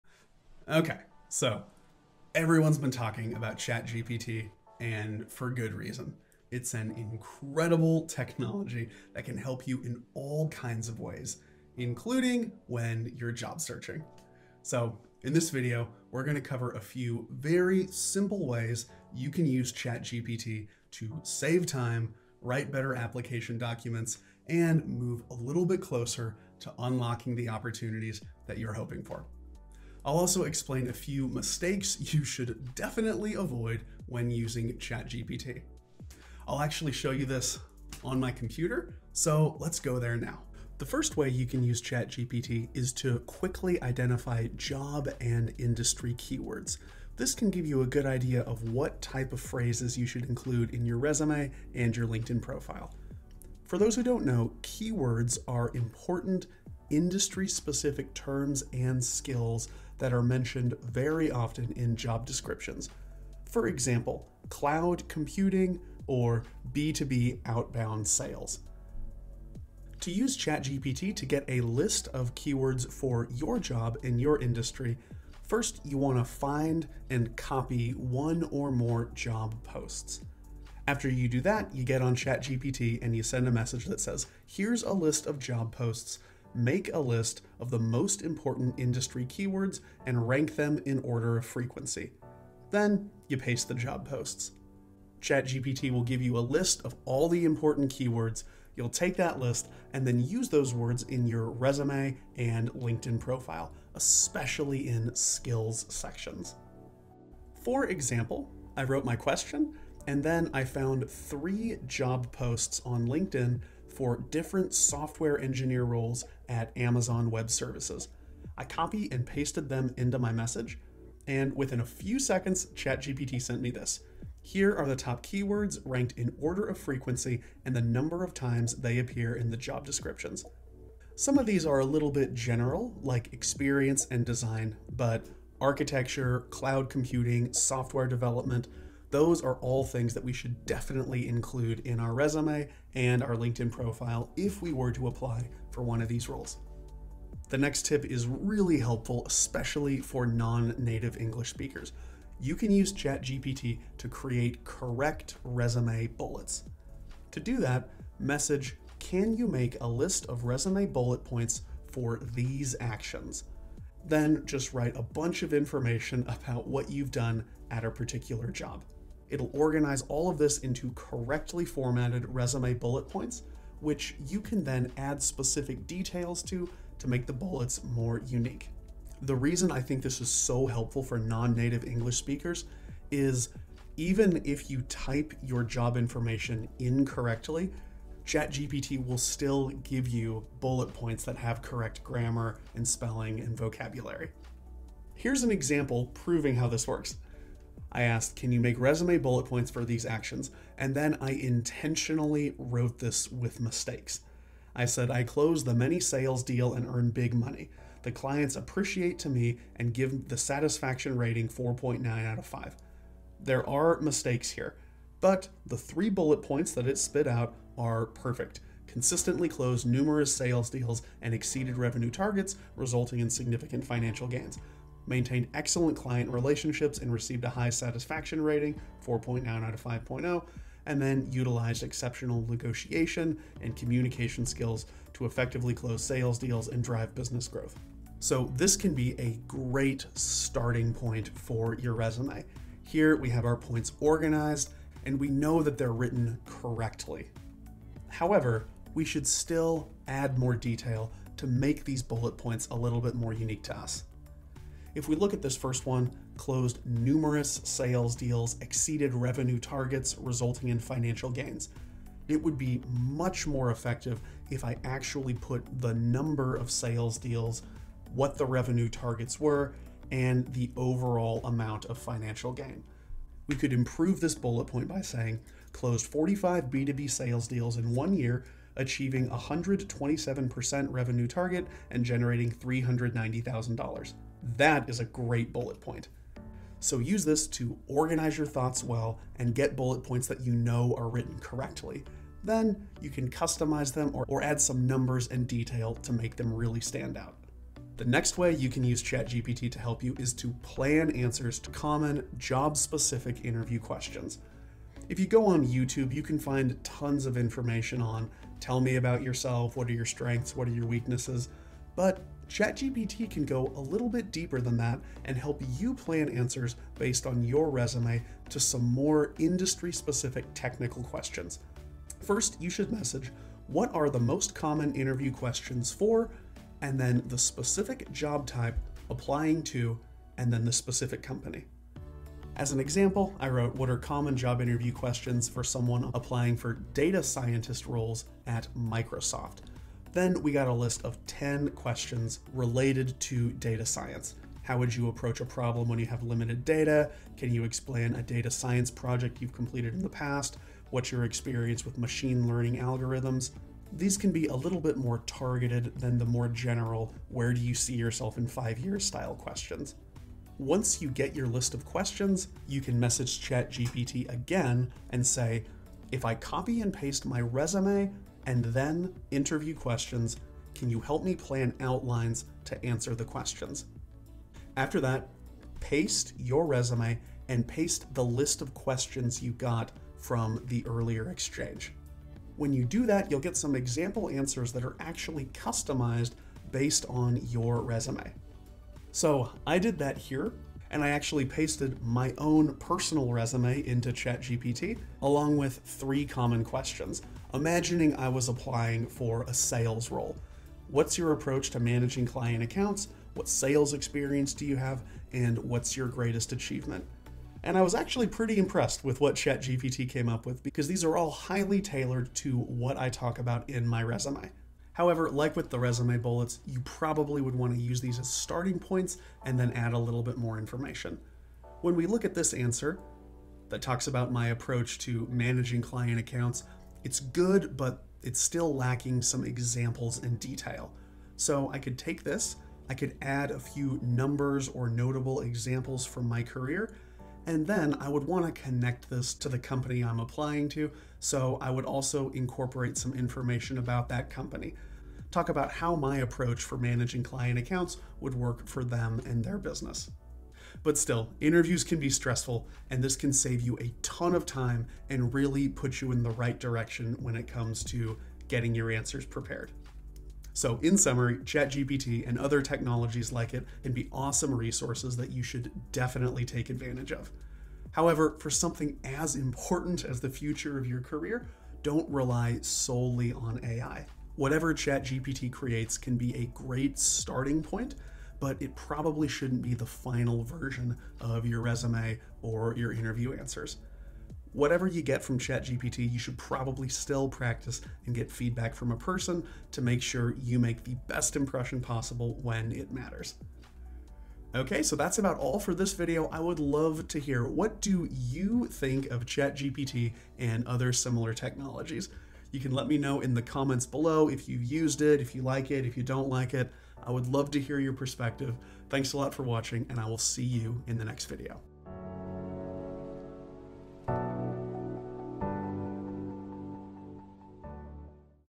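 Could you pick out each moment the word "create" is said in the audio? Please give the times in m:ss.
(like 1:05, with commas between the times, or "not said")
2:34, 7:55.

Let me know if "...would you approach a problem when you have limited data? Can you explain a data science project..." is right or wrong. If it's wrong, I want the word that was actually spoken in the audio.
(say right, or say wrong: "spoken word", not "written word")
right.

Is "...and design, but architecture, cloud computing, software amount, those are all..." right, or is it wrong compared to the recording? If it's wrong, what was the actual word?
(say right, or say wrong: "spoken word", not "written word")
wrong: "development", not "amount".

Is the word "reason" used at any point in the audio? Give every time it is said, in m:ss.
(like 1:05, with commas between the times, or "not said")
0:05, 2:59.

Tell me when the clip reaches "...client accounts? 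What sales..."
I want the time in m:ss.
6:42.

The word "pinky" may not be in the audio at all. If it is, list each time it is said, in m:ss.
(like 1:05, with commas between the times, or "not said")
not said.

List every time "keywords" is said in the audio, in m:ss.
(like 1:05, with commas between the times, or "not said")
0:46, 0:54, 1:12, 1:29, 1:37, 2:05.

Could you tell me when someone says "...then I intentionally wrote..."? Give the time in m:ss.
3:20.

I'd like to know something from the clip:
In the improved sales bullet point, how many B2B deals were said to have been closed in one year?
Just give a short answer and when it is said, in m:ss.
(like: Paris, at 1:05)
45, at 4:36.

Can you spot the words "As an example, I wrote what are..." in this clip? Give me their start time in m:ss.
5:32.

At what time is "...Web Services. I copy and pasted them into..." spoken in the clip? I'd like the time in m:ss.
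1:57.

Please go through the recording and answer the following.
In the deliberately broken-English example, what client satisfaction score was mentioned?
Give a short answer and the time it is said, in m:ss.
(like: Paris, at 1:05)
4.9 out of 5, at 3:31.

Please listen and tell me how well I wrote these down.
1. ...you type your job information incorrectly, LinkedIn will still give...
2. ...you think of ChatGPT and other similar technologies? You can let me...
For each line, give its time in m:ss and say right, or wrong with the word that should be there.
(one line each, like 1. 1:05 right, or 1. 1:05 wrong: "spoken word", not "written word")
1. 3:04 wrong: "ChatGPT", not "LinkedIn"
2. 8:18 right.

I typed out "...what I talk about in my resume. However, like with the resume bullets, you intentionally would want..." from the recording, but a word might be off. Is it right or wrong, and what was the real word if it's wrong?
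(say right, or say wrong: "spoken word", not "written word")
wrong: "probably", not "intentionally".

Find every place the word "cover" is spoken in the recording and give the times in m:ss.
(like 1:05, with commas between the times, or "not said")
0:16.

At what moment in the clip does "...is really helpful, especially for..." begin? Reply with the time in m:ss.
2:28.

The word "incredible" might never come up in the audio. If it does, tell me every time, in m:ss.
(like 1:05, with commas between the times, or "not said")
0:06.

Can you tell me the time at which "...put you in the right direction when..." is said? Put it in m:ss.
7:35.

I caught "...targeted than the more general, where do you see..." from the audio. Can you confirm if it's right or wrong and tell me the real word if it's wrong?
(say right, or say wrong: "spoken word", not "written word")
right.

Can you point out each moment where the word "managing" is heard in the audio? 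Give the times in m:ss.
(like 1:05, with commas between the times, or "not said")
6:41, 7:05, 7:26.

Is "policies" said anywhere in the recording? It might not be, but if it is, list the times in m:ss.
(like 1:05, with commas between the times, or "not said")
not said.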